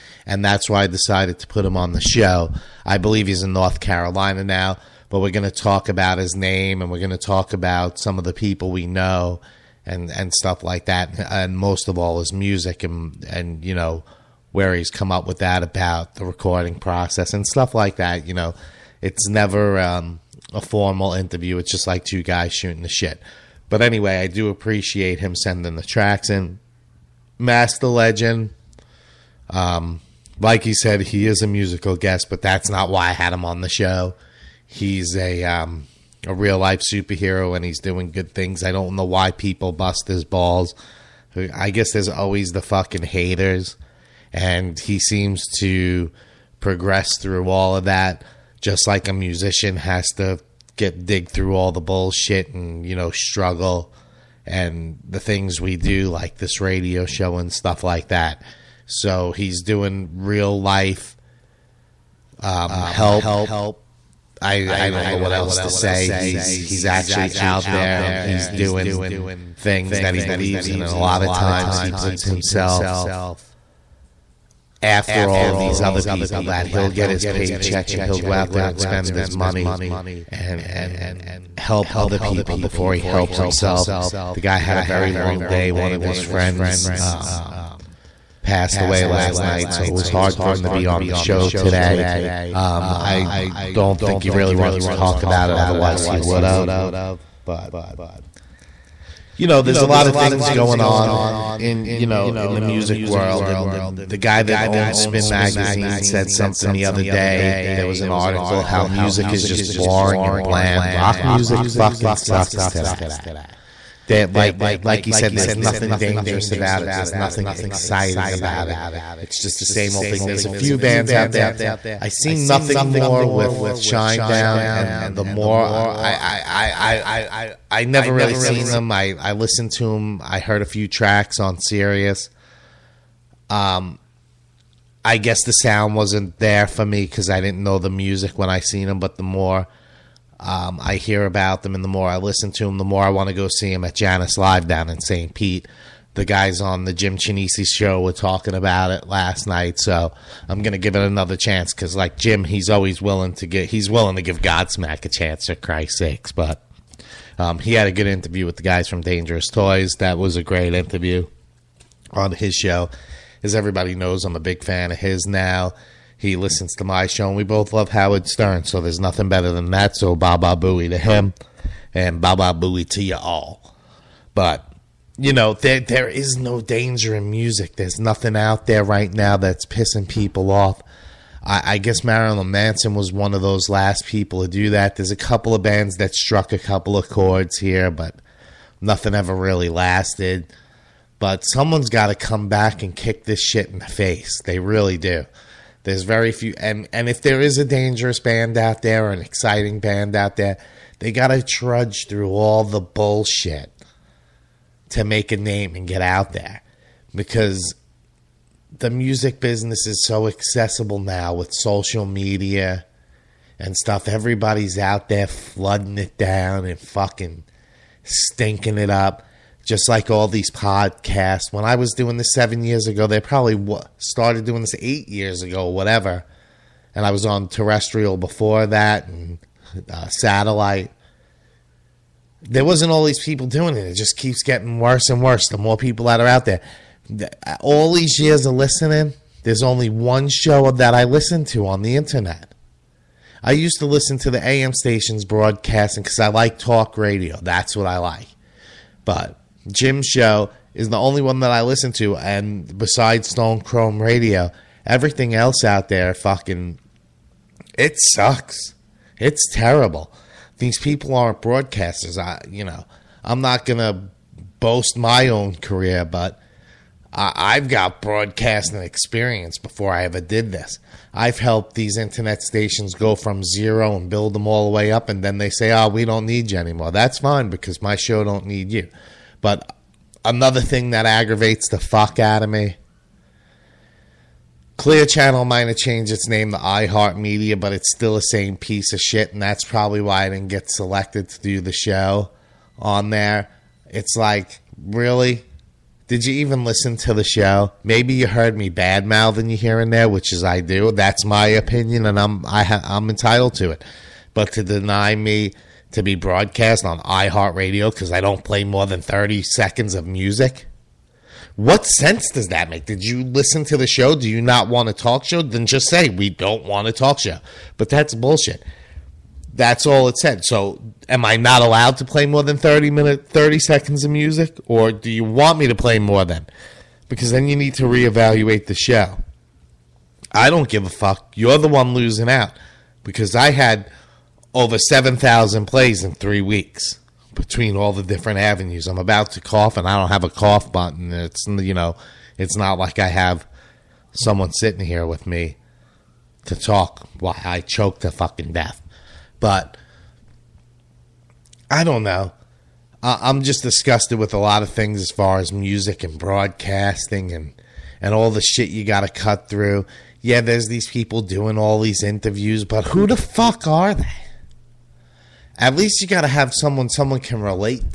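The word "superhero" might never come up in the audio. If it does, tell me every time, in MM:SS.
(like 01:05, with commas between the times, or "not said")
00:36.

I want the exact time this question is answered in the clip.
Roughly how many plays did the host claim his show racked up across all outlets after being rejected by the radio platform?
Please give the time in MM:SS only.
05:34.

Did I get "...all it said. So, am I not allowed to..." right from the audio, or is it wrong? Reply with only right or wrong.
right.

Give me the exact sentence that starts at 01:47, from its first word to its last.
There was an article how music is just boring and bland.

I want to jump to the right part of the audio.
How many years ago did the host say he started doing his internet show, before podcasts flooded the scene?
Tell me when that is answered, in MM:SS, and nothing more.
03:42.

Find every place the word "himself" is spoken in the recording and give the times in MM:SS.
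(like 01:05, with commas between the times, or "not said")
01:12, 01:23.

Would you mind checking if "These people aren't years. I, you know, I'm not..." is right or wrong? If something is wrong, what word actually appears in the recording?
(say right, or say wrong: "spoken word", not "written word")
wrong: "broadcasters", not "years".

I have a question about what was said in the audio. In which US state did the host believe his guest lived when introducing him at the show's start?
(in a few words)
North Carolina.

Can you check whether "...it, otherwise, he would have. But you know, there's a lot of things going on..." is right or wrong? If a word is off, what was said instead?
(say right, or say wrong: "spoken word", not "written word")
right.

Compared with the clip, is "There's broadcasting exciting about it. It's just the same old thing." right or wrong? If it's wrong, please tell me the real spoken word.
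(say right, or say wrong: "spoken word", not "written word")
wrong: "nothing", not "broadcasting".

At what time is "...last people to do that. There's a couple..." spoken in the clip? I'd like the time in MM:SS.
03:03.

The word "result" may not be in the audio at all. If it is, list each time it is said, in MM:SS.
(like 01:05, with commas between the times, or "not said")
not said.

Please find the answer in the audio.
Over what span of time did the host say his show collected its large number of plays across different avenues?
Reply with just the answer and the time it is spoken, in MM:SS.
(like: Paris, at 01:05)
3 weeks, at 05:36.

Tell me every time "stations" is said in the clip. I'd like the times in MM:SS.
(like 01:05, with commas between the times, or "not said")
04:04, 04:32.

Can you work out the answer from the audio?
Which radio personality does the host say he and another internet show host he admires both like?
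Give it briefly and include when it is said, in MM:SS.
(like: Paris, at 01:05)
Howard Stern, at 02:47.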